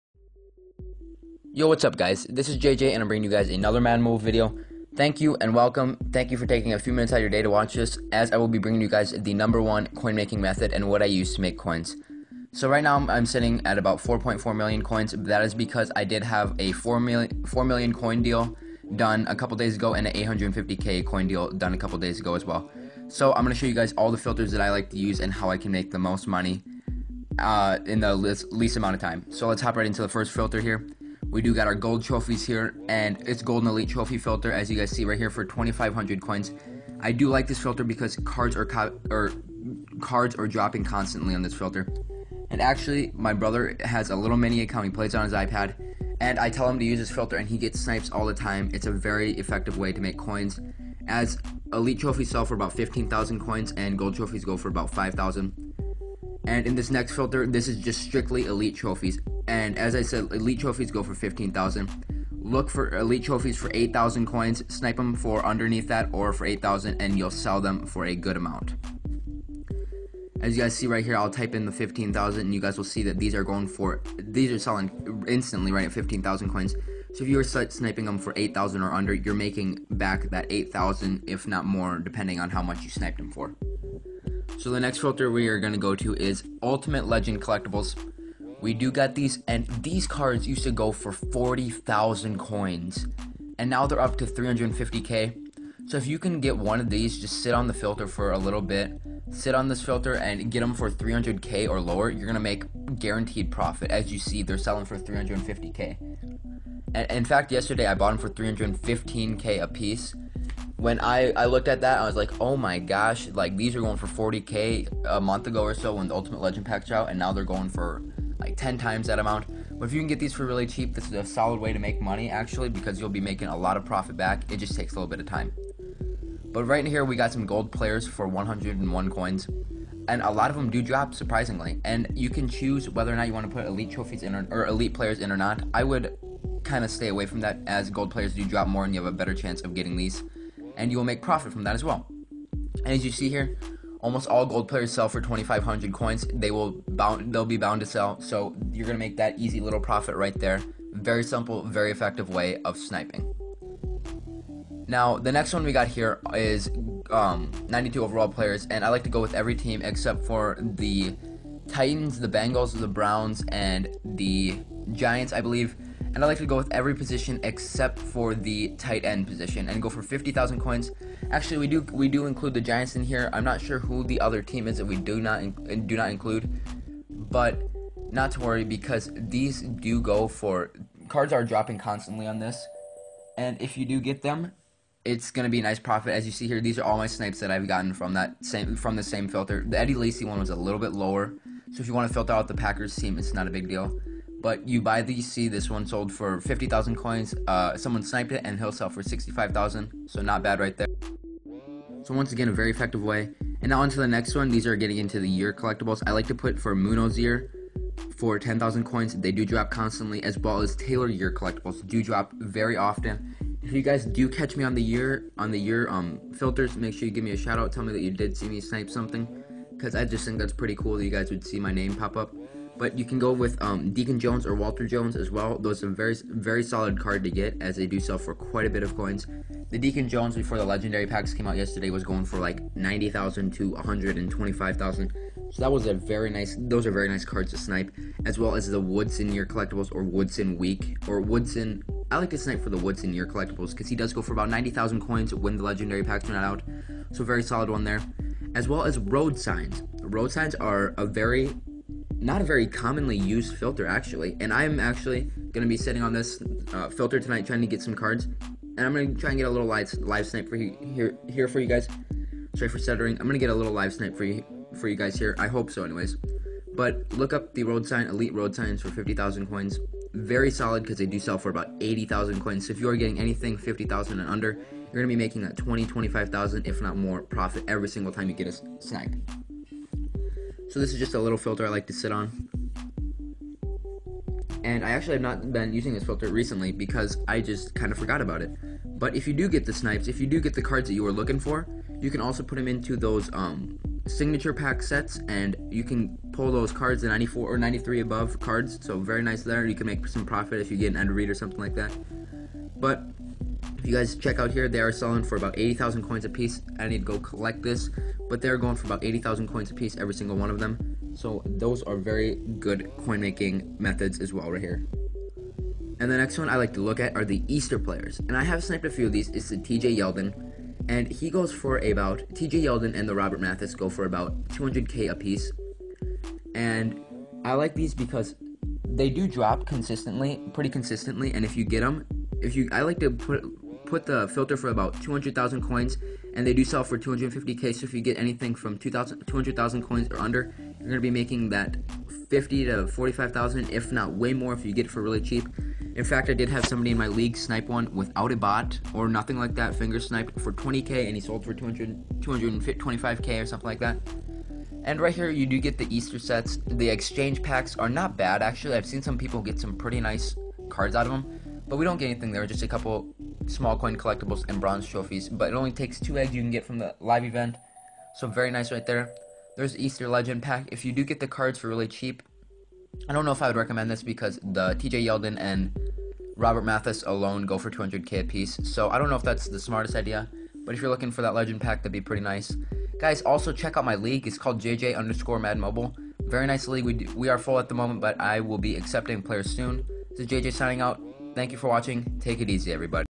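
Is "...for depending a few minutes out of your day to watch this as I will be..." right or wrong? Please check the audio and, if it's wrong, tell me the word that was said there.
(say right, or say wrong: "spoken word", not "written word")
wrong: "taking", not "depending".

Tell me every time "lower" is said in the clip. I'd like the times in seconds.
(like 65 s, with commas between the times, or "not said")
101 s, 190 s.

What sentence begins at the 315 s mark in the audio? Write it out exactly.
And the next one I like to look at are the Easter players.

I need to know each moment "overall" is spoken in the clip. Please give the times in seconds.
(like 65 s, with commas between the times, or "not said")
158 s.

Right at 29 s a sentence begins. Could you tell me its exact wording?
So let's hop right into the first filter here.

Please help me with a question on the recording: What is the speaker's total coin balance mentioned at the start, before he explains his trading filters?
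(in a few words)
4.4 million.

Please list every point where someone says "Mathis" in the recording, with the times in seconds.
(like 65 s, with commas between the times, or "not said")
323 s, 376 s.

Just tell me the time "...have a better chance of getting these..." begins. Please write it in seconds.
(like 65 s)
139 s.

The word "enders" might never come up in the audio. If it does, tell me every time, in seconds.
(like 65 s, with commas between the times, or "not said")
not said.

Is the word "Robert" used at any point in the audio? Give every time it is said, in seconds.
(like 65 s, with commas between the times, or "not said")
323 s, 376 s.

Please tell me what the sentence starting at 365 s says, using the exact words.
But it only takes two eggs you can get from the live event.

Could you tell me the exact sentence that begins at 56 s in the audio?
And in this next filter, this is just strictly elite trophies.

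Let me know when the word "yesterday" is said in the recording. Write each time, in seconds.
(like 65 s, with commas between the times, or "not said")
107 s, 231 s.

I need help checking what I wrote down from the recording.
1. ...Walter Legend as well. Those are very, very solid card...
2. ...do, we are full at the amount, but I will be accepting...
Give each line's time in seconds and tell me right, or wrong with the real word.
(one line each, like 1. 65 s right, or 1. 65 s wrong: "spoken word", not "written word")
1. 224 s wrong: "Jones", not "Legend"
2. 386 s wrong: "moment", not "amount".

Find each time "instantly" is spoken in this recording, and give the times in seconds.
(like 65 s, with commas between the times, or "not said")
75 s.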